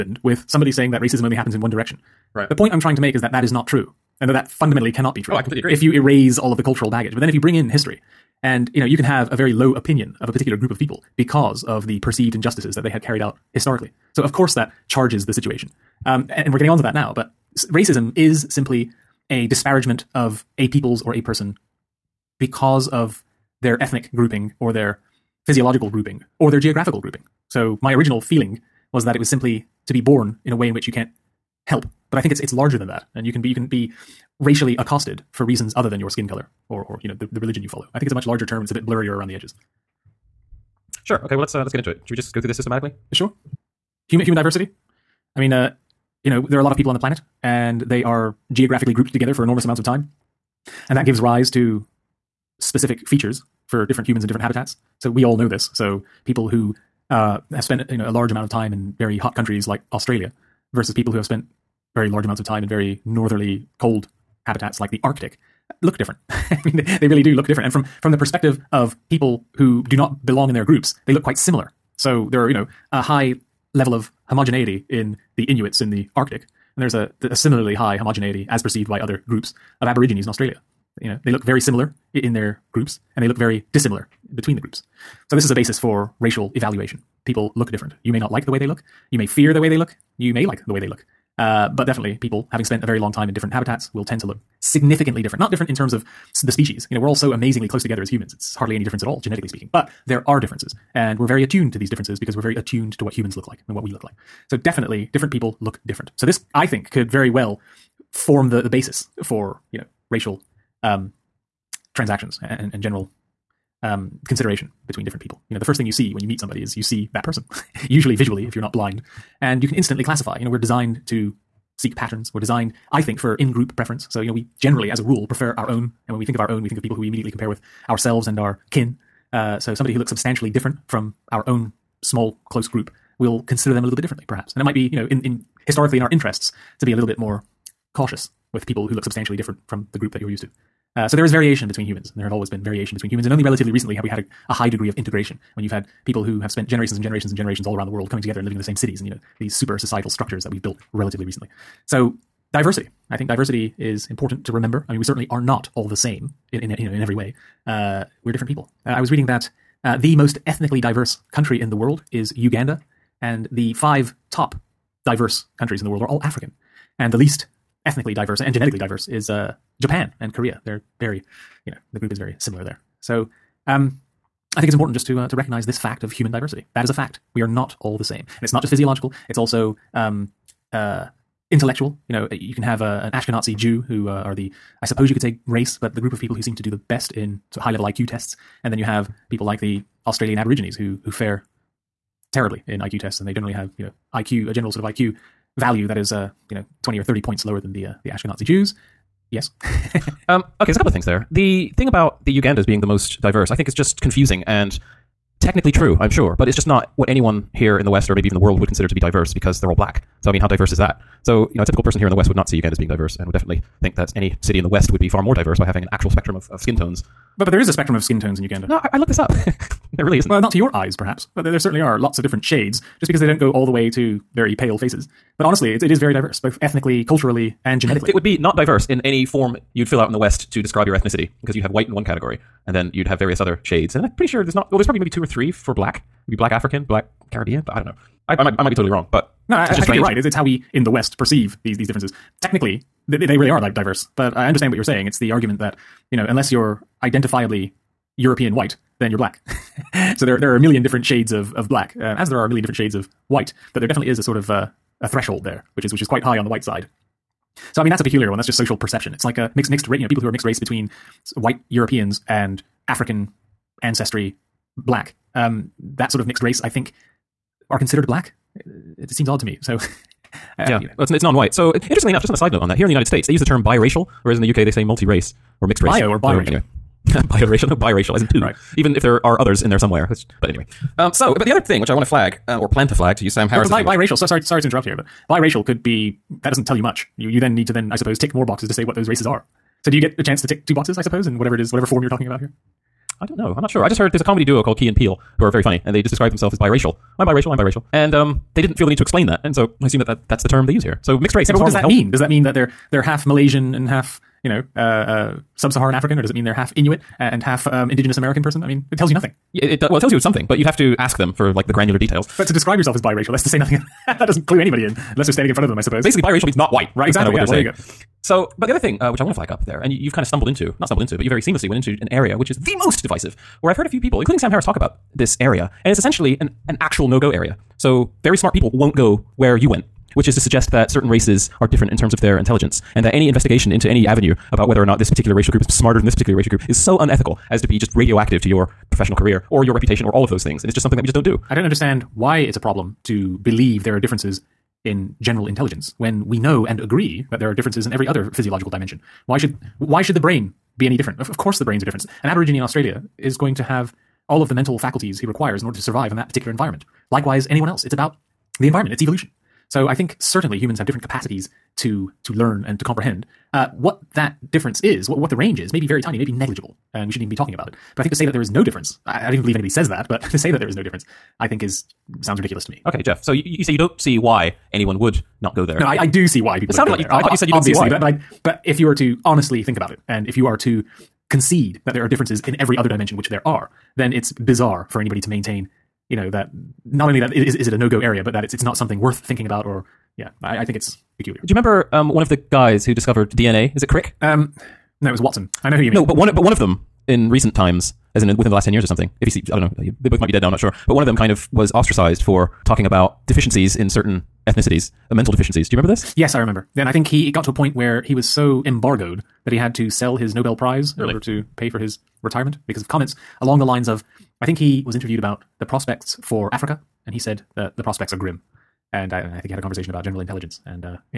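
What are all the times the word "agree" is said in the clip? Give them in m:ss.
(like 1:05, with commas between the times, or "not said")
0:05, 5:46.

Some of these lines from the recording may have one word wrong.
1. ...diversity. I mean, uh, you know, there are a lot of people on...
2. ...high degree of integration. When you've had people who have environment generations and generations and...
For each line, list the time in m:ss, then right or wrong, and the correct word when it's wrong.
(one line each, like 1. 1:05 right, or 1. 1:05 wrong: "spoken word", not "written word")
1. 0:44 right
2. 2:24 wrong: "spent", not "environment".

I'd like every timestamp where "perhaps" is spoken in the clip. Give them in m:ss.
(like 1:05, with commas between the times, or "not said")
2:14, 3:40.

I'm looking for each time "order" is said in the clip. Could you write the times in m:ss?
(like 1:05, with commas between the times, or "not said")
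5:55, 6:51.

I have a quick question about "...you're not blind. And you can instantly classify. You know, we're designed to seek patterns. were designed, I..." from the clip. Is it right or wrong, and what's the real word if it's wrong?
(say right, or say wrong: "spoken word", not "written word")
right.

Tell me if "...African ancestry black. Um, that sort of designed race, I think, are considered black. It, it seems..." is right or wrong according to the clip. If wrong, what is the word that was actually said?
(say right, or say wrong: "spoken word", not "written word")
wrong: "mixed", not "designed".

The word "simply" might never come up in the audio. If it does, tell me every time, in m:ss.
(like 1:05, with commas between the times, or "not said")
0:18, 0:29.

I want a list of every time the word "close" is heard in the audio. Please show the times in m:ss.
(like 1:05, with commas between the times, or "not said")
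1:37, 2:12.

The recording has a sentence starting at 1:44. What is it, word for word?
So definitely different people look different.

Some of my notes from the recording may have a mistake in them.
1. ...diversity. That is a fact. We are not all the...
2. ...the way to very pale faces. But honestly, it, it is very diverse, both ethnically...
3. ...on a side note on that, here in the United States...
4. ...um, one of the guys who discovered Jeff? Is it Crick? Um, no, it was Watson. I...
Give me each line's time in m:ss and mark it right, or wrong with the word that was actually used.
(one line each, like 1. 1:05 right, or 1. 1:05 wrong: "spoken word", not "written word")
1. 2:56 right
2. 3:43 right
3. 4:32 right
4. 6:31 wrong: "DNA", not "Jeff".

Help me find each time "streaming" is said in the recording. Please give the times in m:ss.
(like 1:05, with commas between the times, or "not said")
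not said.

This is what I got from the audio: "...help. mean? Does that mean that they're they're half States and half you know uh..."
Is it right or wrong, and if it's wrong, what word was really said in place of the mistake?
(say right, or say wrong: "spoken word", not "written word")
wrong: "Malaysian", not "States".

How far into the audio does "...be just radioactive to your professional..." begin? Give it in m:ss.
5:37.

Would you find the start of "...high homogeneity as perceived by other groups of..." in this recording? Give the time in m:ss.
1:17.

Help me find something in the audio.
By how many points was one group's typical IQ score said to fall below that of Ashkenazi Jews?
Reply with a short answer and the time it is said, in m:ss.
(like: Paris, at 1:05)
20 or 30, at 3:16.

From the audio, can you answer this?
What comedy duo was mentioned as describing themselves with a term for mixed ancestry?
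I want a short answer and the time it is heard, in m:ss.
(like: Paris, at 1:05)
Key and Peele, at 4:54.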